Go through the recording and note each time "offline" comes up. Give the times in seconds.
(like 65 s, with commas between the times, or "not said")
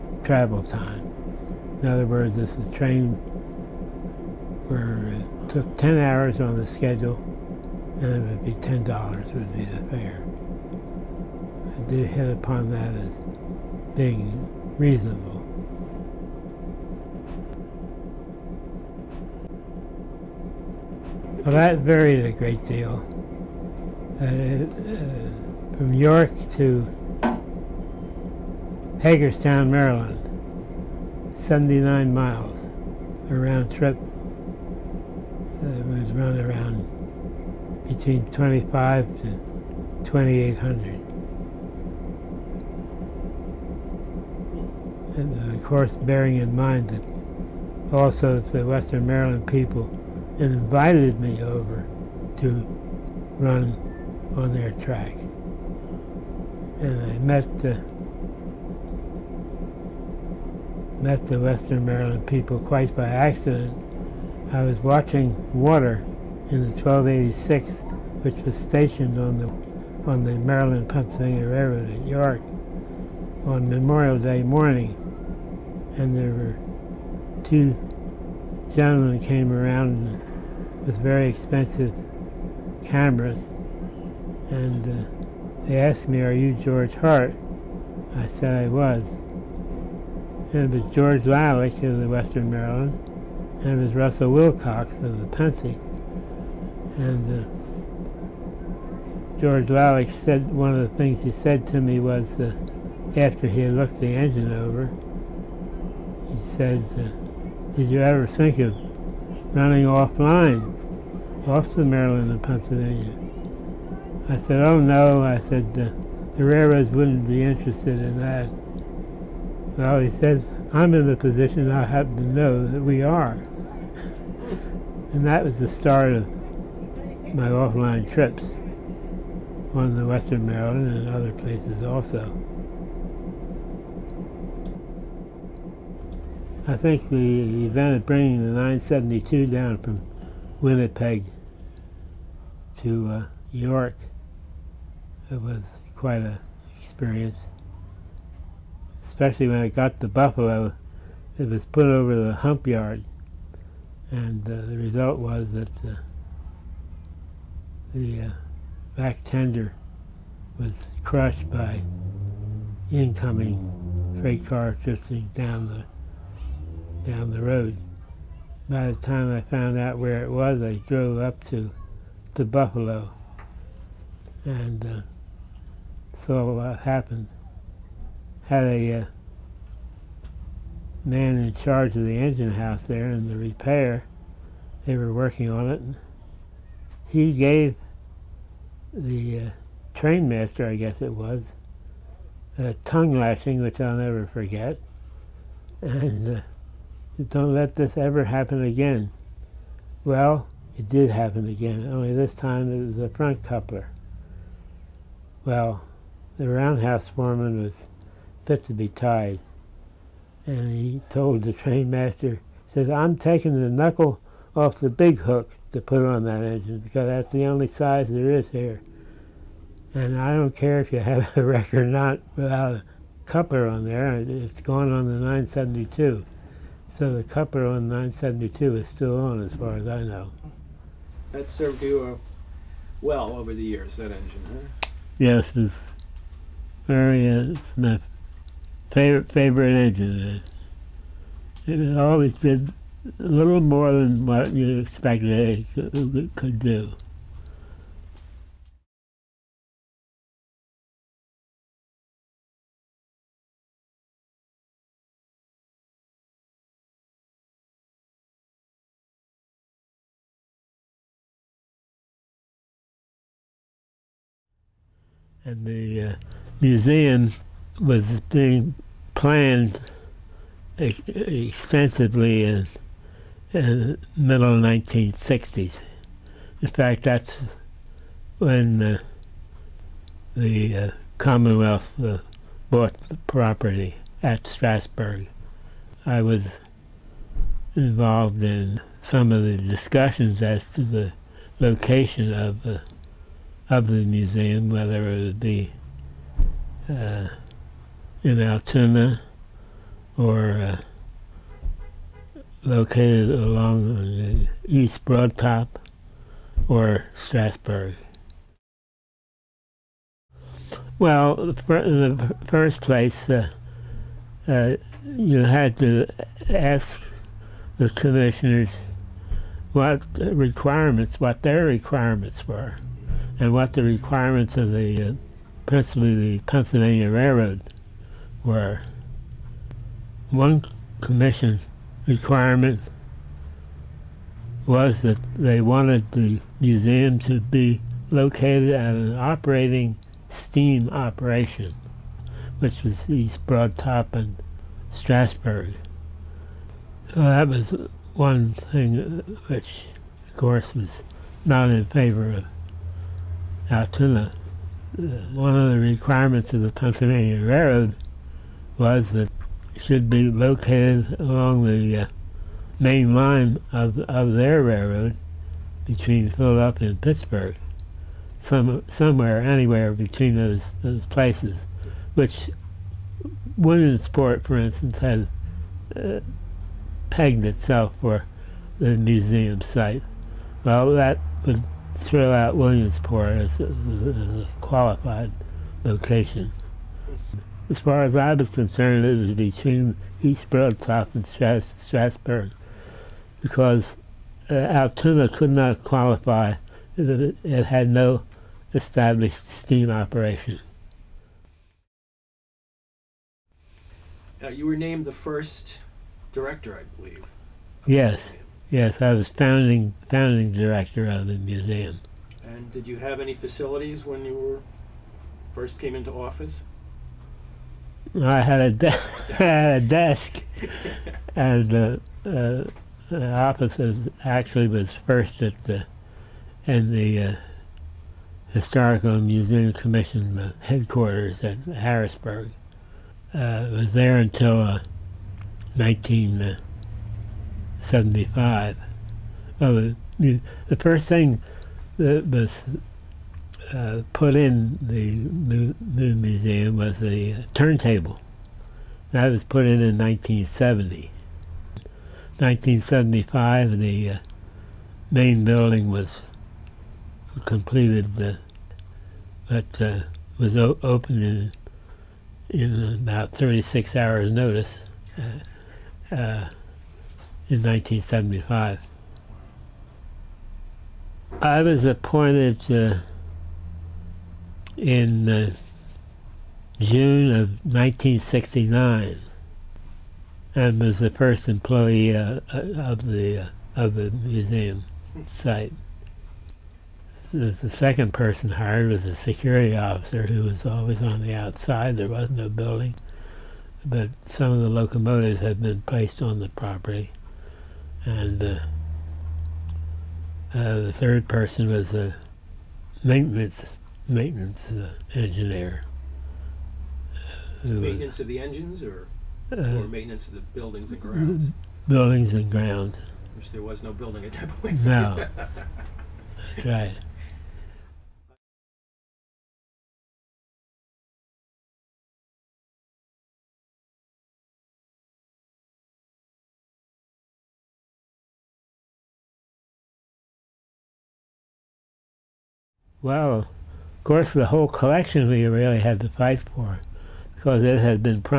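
109 s, 127 s.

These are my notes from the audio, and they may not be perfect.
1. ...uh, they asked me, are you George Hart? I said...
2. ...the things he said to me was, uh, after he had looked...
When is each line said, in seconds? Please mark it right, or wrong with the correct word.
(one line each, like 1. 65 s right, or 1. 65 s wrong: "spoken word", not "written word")
1. 84 s right
2. 100 s right.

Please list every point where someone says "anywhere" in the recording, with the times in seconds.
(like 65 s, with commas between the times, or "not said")
369 s.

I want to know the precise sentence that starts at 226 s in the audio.
So the coupler on 972 is still on, as far as I know.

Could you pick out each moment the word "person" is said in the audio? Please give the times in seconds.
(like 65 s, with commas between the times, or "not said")
488 s, 501 s.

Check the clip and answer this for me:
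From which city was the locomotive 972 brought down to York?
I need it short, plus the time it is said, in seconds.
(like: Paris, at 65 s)
Winnipeg, at 140 s.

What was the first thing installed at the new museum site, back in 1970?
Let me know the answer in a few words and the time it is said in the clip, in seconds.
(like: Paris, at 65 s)
A turntable, at 447 s.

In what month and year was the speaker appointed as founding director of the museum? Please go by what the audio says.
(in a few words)
June 1969.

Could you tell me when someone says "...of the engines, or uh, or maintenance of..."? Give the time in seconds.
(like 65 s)
508 s.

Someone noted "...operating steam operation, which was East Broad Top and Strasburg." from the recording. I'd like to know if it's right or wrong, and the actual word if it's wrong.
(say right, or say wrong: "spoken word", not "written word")
right.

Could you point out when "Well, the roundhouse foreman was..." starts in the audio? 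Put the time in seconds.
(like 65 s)
205 s.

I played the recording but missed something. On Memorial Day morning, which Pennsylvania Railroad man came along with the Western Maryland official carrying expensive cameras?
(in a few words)
Russell Wilcox.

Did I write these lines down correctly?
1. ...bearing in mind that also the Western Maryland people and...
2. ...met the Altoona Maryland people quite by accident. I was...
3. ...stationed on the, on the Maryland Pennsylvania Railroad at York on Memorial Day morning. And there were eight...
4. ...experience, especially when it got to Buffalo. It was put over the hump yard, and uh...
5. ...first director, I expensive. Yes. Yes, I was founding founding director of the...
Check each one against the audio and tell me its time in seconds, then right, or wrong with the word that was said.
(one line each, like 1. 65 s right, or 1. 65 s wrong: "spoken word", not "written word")
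1. 45 s right
2. 61 s wrong: "Western", not "Altoona"
3. 68 s wrong: "two", not "eight"
4. 146 s right
5. 405 s wrong: "believe", not "expensive".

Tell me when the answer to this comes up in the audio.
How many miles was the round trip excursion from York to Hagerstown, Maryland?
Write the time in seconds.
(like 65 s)
31 s.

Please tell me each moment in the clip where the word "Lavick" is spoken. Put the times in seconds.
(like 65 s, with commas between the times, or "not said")
91 s, 99 s.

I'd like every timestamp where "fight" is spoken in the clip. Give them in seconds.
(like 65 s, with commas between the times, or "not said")
536 s.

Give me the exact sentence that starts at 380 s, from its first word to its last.
Well, that would throw out Williamsport as a, qualified location.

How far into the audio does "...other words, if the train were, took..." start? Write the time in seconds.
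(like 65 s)
1 s.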